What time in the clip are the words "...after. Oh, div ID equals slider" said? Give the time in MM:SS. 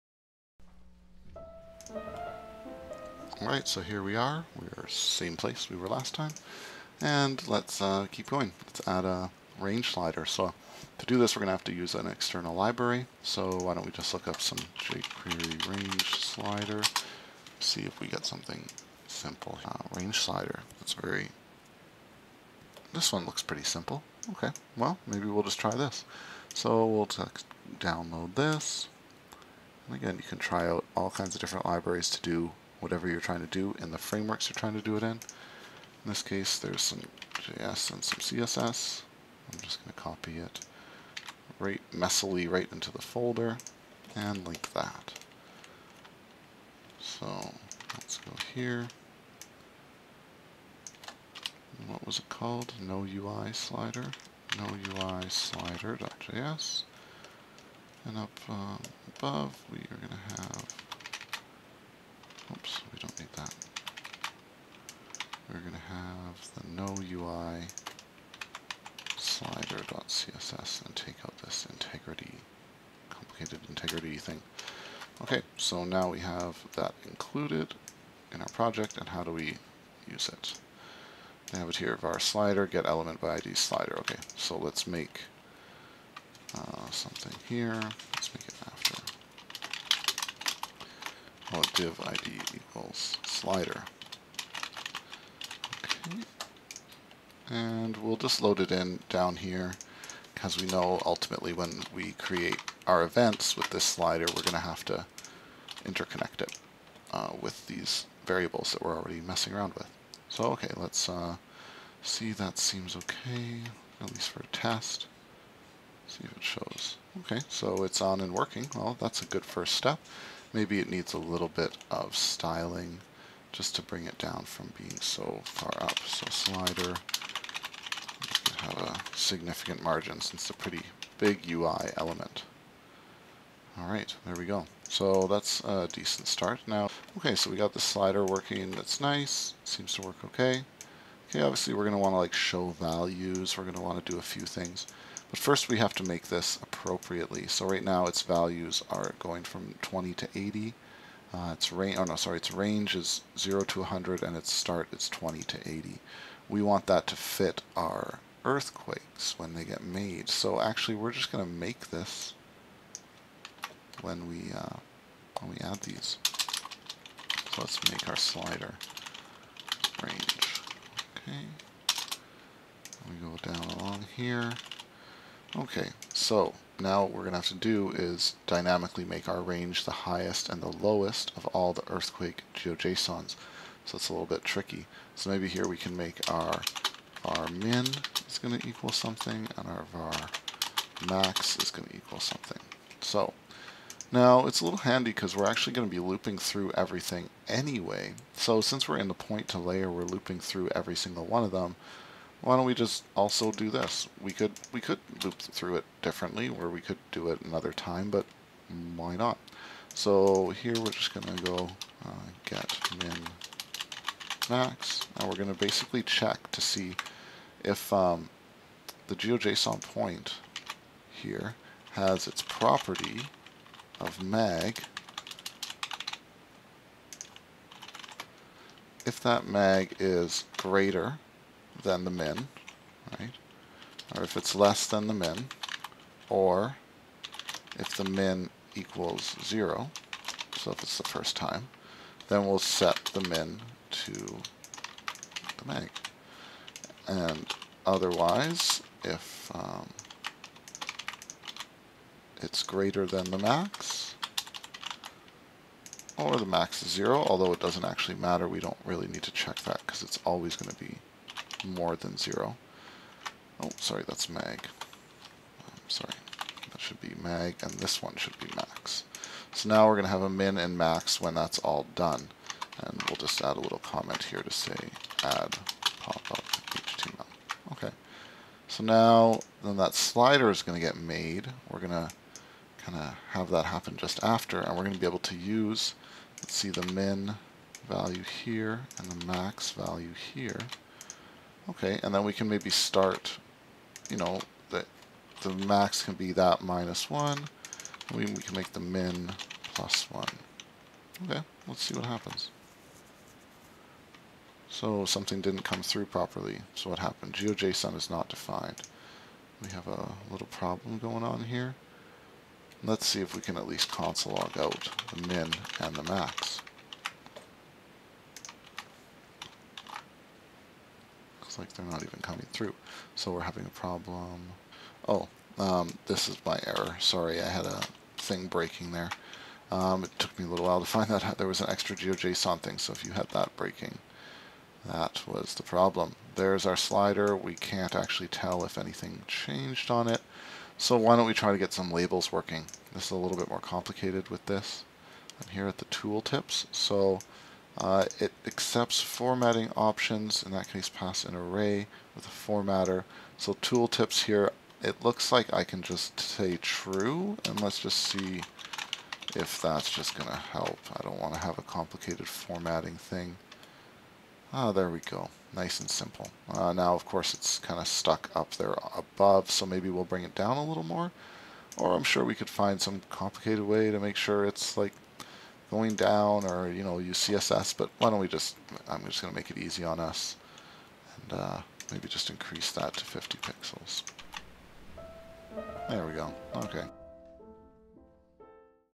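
01:28.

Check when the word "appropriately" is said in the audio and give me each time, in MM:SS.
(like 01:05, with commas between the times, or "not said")
02:26.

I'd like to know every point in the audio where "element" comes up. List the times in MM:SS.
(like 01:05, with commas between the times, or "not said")
01:22, 02:11.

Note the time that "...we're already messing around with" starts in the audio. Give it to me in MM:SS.
01:48.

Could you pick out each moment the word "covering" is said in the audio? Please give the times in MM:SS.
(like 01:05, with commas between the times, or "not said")
not said.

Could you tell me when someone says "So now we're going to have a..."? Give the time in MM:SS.
04:29.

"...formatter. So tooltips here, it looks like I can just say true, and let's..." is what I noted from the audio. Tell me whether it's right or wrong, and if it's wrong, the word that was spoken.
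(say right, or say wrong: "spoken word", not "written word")
right.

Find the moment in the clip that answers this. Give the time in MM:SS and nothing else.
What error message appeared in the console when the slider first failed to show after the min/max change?
05:07.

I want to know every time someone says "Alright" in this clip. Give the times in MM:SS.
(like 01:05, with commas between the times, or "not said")
00:03, 02:13.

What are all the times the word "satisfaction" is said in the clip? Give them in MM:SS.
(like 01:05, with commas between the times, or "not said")
not said.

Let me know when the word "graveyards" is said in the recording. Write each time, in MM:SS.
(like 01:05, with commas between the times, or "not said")
not said.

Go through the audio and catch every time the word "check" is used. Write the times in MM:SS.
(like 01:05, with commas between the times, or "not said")
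03:36, 04:19.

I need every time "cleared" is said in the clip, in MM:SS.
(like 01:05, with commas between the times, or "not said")
not said.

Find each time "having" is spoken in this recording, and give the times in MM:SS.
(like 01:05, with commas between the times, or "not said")
05:23.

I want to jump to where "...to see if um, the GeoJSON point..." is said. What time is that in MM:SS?
03:36.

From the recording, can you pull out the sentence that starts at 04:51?
Okay, and then we can maybe start, you know, the, the max can be that minus 1.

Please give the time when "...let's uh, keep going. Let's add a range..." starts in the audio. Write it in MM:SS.
00:07.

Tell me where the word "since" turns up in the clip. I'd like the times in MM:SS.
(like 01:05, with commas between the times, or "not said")
02:10, 03:18.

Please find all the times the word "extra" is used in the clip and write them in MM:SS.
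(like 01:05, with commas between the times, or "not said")
05:31.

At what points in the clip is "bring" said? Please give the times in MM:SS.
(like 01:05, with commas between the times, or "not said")
02:03, 06:10.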